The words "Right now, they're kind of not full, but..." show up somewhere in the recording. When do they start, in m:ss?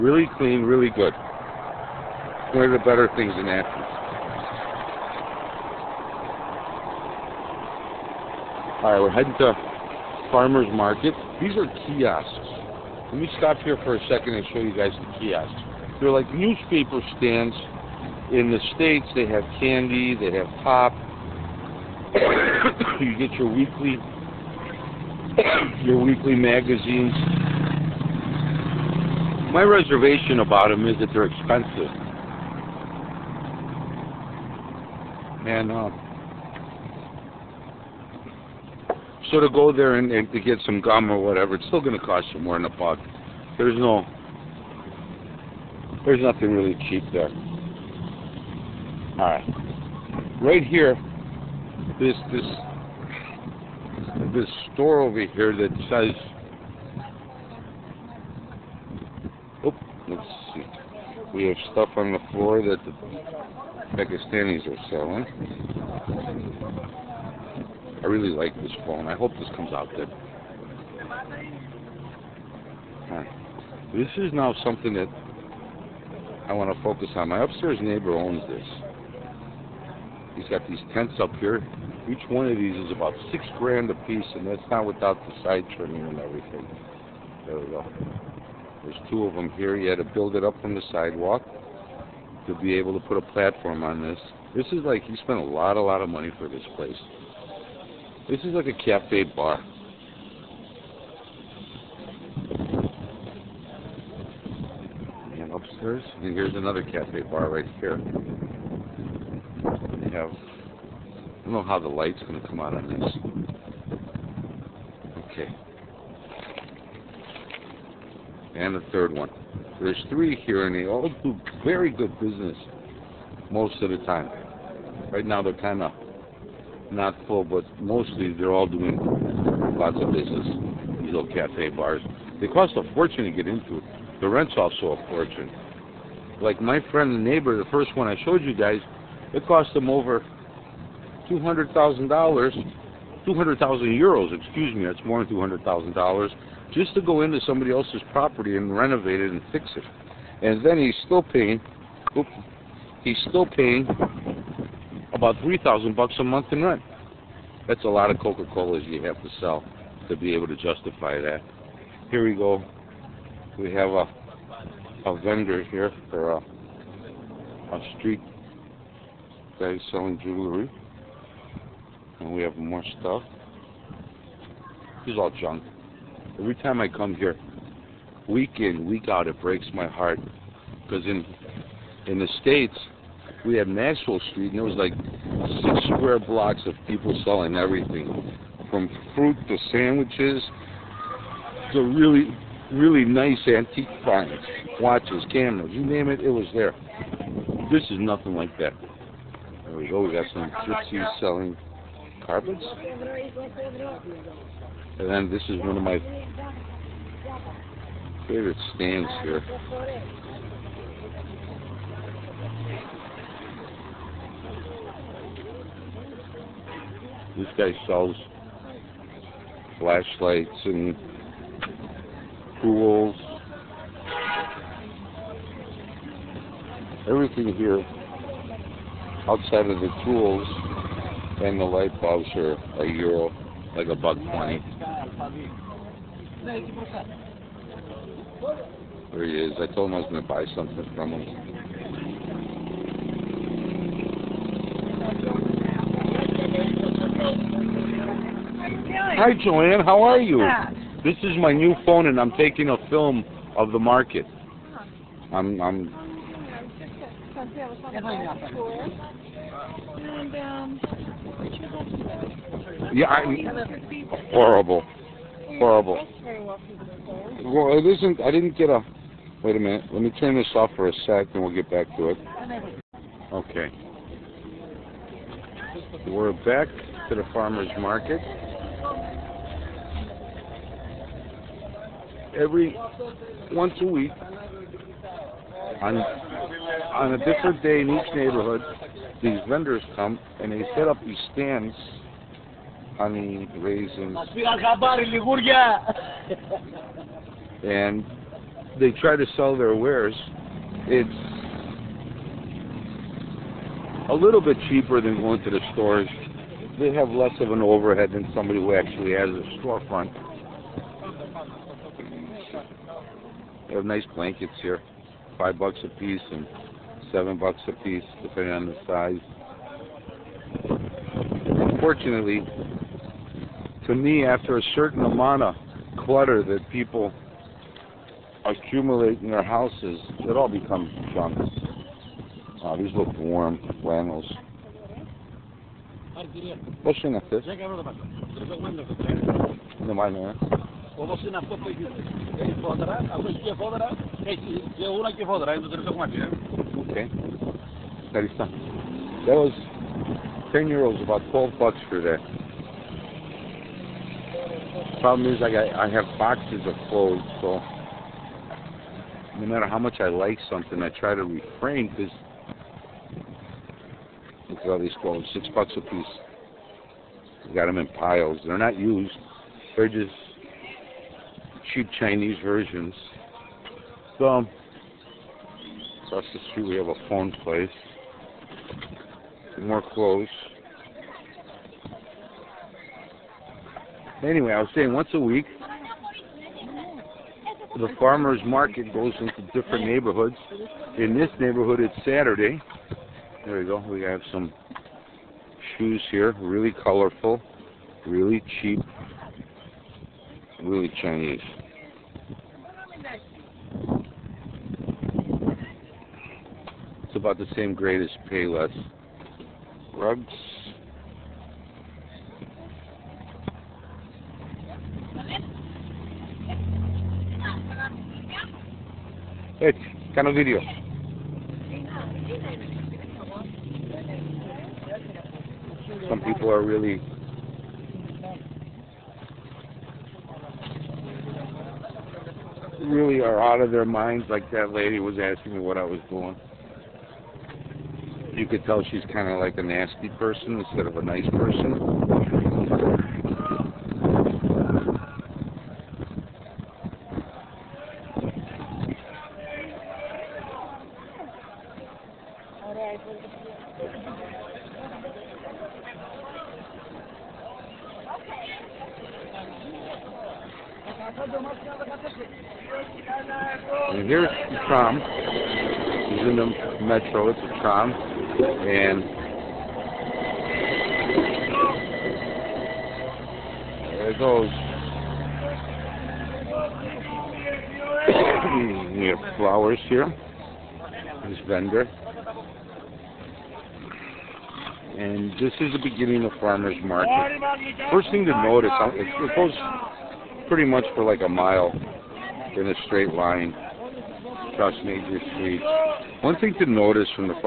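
2:05.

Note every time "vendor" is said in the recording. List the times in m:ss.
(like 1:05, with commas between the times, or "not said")
2:45, 4:49, 8:01.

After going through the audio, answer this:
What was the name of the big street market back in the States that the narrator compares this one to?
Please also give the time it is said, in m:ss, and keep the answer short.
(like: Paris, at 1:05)
Maxwell Street, at 3:03.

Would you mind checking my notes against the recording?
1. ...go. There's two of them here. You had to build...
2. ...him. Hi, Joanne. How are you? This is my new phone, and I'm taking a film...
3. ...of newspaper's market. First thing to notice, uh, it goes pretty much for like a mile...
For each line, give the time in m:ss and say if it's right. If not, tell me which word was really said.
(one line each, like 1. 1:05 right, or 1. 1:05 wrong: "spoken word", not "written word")
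1. 1:27 right
2. 4:01 right
3. 8:06 wrong: "farmer", not "newspaper".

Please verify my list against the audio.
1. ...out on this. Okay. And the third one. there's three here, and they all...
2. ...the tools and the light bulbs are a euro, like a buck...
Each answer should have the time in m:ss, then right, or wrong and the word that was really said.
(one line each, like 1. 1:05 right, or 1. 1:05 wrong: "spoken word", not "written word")
1. 1:52 right
2. 3:49 right.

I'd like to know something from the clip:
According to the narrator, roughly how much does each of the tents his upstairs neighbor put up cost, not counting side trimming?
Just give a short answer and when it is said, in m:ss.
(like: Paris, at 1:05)
6 grand, at 1:23.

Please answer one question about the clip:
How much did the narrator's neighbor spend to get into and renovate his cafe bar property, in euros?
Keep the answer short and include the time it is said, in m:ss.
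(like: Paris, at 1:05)
200,000 euros, at 2:23.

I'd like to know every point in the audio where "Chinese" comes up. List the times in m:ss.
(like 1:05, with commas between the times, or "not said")
6:12, 6:41.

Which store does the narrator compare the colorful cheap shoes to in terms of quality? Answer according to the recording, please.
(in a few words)
Payless.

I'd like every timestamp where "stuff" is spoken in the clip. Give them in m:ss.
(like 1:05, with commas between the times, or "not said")
1:01, 2:53.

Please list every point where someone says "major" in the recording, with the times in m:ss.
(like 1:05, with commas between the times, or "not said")
8:14.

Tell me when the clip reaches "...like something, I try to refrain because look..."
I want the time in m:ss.
6:00.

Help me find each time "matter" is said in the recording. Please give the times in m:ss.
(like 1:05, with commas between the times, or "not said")
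5:59.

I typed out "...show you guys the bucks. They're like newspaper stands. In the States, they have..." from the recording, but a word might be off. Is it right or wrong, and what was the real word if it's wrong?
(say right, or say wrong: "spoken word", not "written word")
wrong: "kiosks", not "bucks".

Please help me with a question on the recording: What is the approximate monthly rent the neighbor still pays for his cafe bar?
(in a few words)
3,000 bucks.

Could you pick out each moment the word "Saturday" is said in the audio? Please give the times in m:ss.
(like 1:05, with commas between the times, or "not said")
6:31.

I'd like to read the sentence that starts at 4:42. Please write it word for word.
every once a week on on a different day in each neighborhood.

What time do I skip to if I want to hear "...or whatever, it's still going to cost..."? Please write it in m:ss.
0:41.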